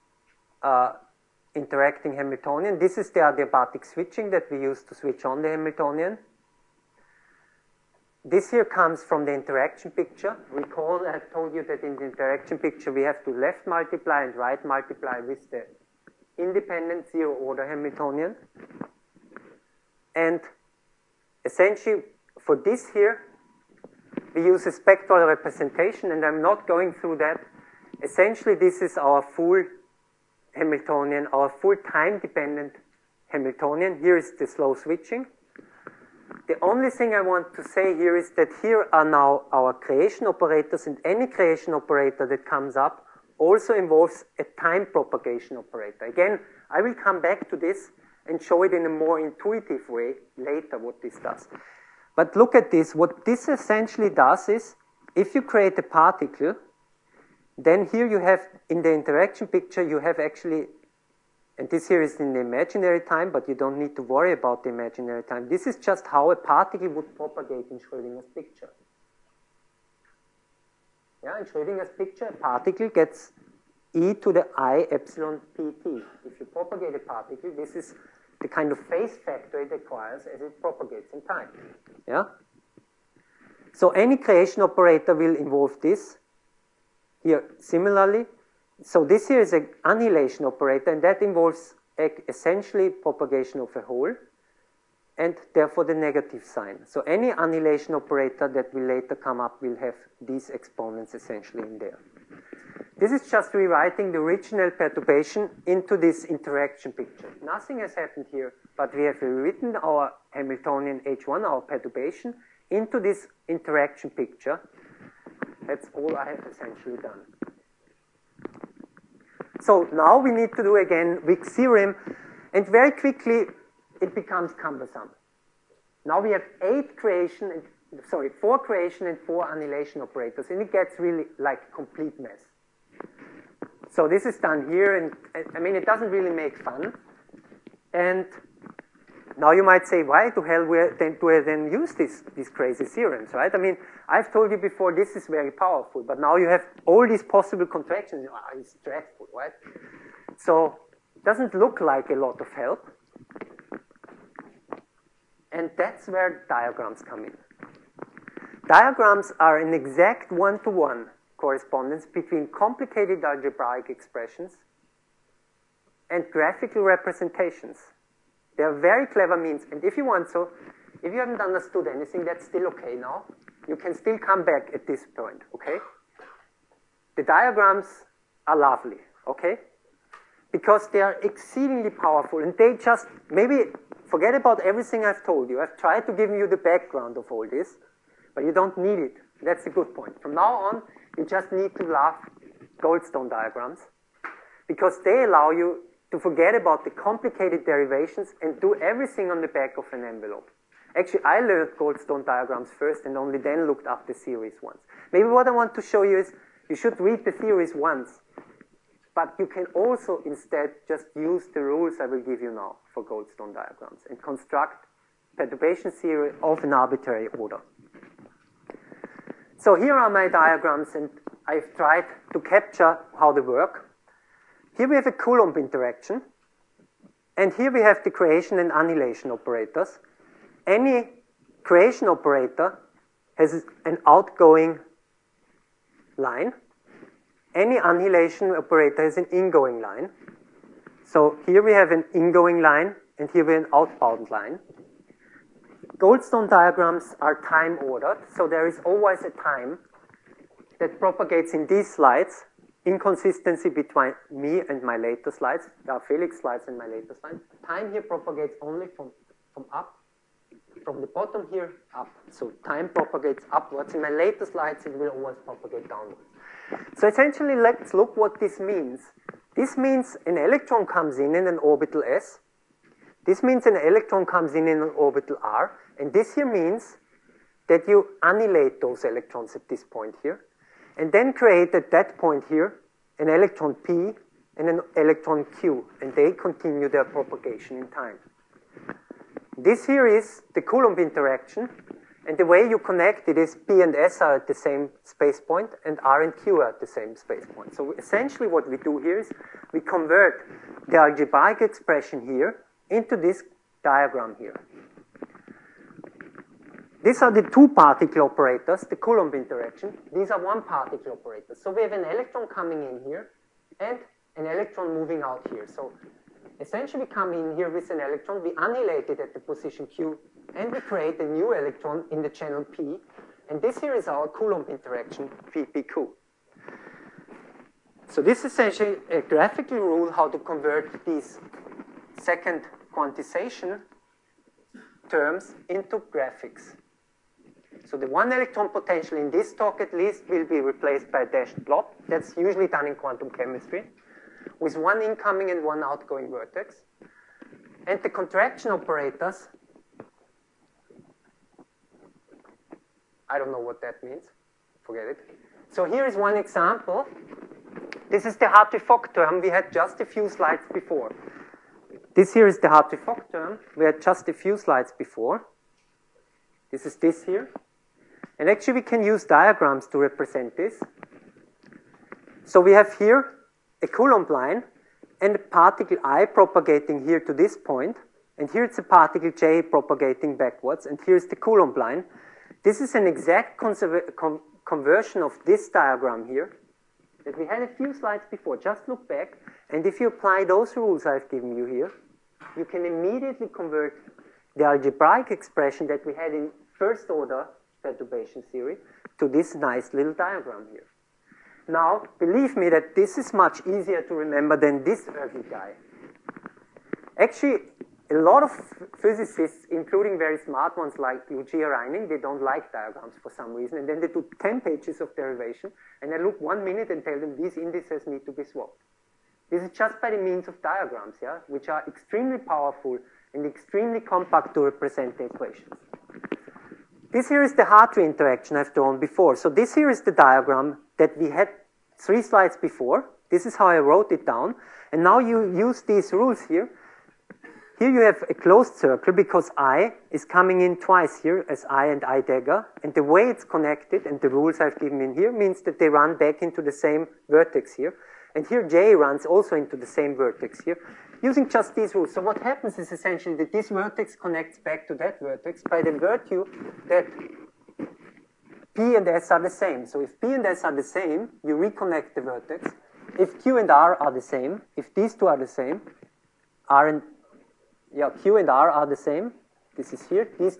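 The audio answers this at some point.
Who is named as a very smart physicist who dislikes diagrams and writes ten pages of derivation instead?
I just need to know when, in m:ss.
6:51.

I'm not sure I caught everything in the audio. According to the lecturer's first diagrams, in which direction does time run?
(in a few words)
Upwards.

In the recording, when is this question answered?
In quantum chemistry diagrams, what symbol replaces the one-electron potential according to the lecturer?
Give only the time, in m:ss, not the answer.
5:41.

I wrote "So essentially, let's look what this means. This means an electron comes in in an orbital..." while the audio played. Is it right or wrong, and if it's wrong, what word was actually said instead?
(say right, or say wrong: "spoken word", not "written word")
right.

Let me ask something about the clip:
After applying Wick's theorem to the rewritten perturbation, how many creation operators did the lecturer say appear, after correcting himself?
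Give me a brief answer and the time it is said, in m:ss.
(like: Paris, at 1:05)
4, at 2:08.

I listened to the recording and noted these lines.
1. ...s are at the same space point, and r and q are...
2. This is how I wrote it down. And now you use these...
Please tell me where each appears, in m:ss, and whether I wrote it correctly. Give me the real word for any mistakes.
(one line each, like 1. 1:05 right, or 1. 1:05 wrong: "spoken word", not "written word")
1. 4:53 right
2. 7:13 right.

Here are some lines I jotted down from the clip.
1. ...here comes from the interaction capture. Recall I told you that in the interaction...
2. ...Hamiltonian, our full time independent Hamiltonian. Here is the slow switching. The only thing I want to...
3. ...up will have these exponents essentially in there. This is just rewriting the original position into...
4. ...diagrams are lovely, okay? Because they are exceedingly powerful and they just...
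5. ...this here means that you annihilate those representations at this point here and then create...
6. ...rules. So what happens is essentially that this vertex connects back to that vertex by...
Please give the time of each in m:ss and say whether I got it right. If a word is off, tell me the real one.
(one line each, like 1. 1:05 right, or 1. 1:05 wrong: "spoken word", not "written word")
1. 0:08 wrong: "picture", not "capture"
2. 0:30 wrong: "dependent", not "independent"
3. 1:39 wrong: "perturbation", not "position"
4. 2:57 right
5. 4:36 wrong: "electrons", not "representations"
6. 7:31 right.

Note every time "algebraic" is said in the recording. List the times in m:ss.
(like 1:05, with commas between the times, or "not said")
2:43, 5:00, 6:34.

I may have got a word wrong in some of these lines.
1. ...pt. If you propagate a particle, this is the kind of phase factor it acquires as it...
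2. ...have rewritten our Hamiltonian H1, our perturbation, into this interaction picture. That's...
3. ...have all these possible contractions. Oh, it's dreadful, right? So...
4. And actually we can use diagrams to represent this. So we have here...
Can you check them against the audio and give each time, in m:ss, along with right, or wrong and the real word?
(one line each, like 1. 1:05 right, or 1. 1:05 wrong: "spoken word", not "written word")
1. 1:15 right
2. 1:49 right
3. 2:26 right
4. 6:08 right.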